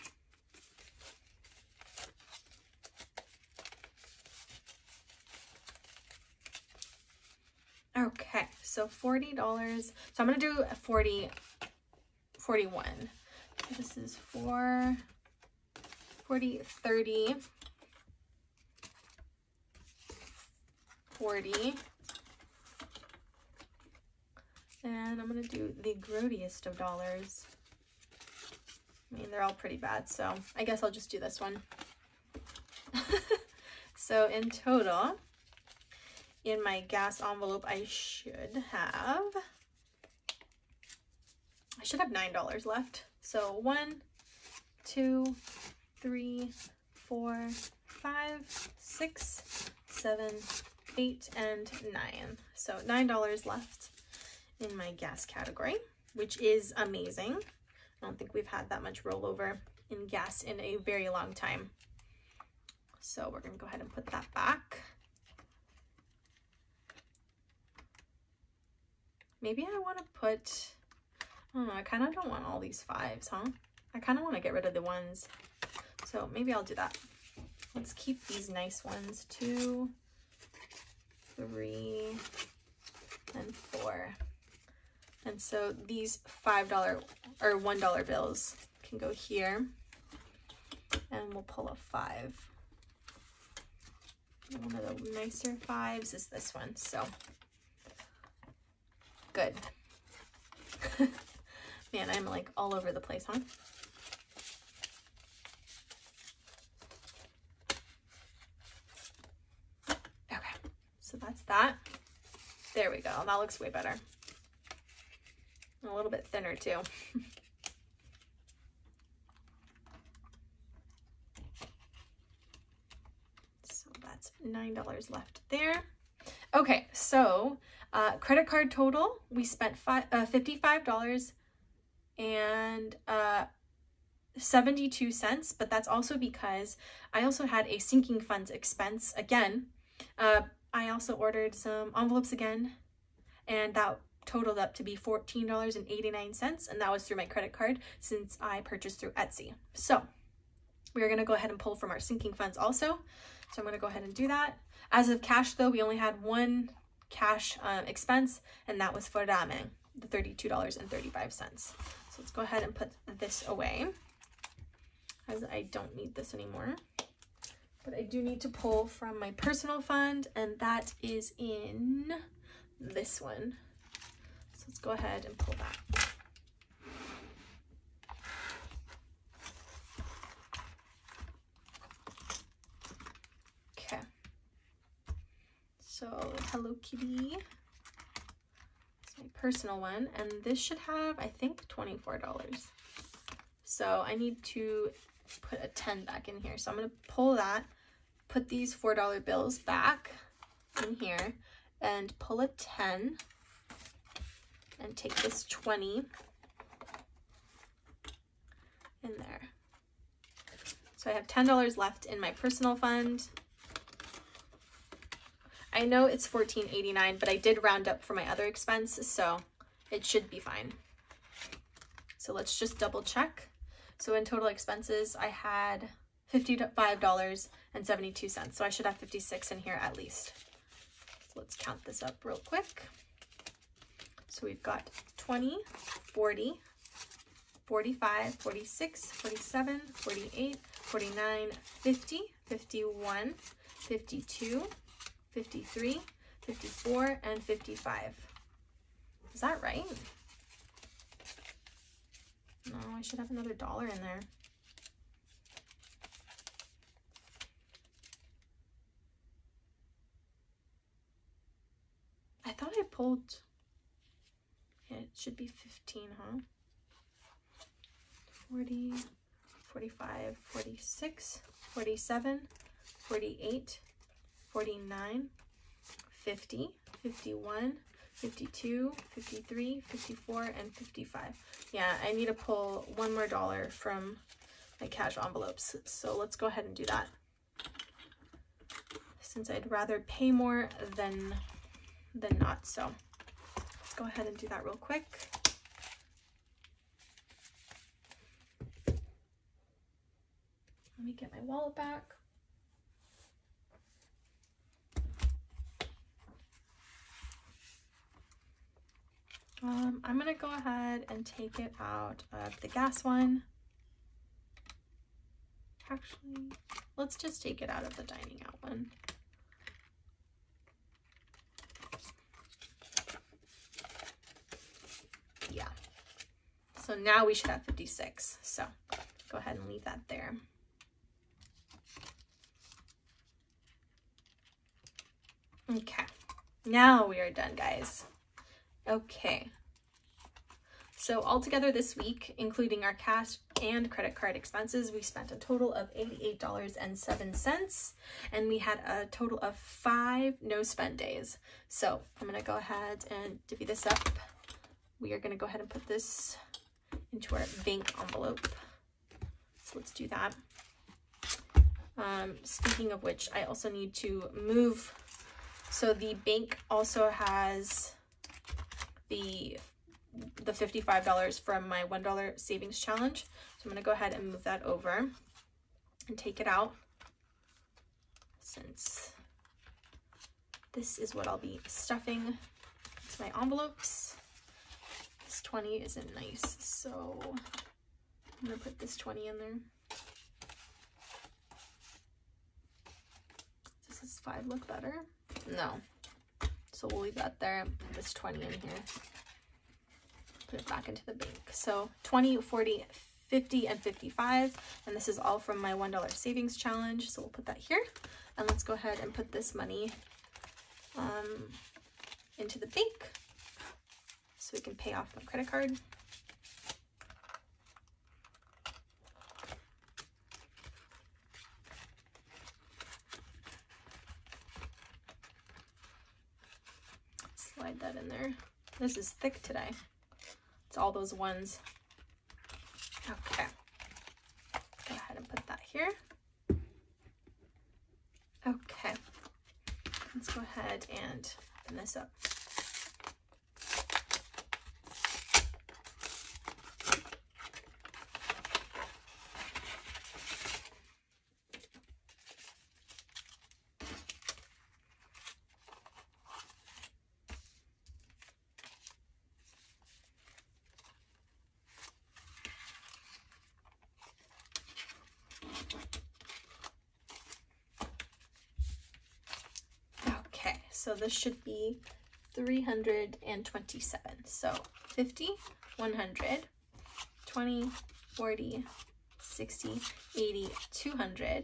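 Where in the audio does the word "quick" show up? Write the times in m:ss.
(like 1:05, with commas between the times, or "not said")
3:52, 4:54.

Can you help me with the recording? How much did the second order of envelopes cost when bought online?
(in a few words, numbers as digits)
$14.89.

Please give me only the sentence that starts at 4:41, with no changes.
Yeah, I need to pull one more dollar from my cash envelopes.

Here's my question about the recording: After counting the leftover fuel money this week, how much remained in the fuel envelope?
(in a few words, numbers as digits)
$9.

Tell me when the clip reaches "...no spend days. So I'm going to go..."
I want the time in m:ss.
5:50.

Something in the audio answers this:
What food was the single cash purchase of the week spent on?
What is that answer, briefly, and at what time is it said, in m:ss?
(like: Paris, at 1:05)
ramen, at 2:39.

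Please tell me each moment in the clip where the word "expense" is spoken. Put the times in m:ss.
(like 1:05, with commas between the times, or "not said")
2:18, 2:37, 3:38, 3:44, 5:44.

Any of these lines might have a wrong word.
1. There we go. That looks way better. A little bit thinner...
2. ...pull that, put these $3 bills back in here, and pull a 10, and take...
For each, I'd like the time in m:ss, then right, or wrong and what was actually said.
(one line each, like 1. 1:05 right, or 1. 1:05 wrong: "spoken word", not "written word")
1. 1:52 right
2. 3:17 wrong: "4", not "3".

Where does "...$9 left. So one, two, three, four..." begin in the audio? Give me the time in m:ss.
0:42.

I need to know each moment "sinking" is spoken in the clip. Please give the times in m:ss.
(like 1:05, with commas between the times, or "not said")
2:17, 2:31.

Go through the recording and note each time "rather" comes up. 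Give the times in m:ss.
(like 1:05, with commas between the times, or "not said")
4:49.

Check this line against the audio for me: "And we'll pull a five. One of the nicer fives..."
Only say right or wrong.
right.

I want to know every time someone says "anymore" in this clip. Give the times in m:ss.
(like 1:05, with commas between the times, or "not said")
2:46.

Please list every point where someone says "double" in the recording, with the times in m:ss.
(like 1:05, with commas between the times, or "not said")
3:42.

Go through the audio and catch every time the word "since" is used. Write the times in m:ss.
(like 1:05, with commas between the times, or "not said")
2:27, 4:49, 6:18.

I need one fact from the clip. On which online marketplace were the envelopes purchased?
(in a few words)
Etsy.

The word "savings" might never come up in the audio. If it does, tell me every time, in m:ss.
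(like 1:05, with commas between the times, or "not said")
6:12, 6:46.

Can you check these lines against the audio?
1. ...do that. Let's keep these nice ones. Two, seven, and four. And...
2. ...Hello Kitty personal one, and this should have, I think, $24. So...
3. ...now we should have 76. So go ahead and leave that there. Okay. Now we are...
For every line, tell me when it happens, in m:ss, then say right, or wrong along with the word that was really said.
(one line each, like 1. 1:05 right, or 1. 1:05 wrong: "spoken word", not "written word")
1. 1:16 wrong: "three", not "seven"
2. 3:06 right
3. 5:26 wrong: "56", not "76".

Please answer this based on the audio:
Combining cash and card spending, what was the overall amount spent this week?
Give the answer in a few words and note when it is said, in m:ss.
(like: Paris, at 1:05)
$88.07, at 5:45.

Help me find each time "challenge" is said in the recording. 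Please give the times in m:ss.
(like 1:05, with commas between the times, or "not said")
6:12, 6:46.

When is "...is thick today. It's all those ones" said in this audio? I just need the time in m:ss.
7:08.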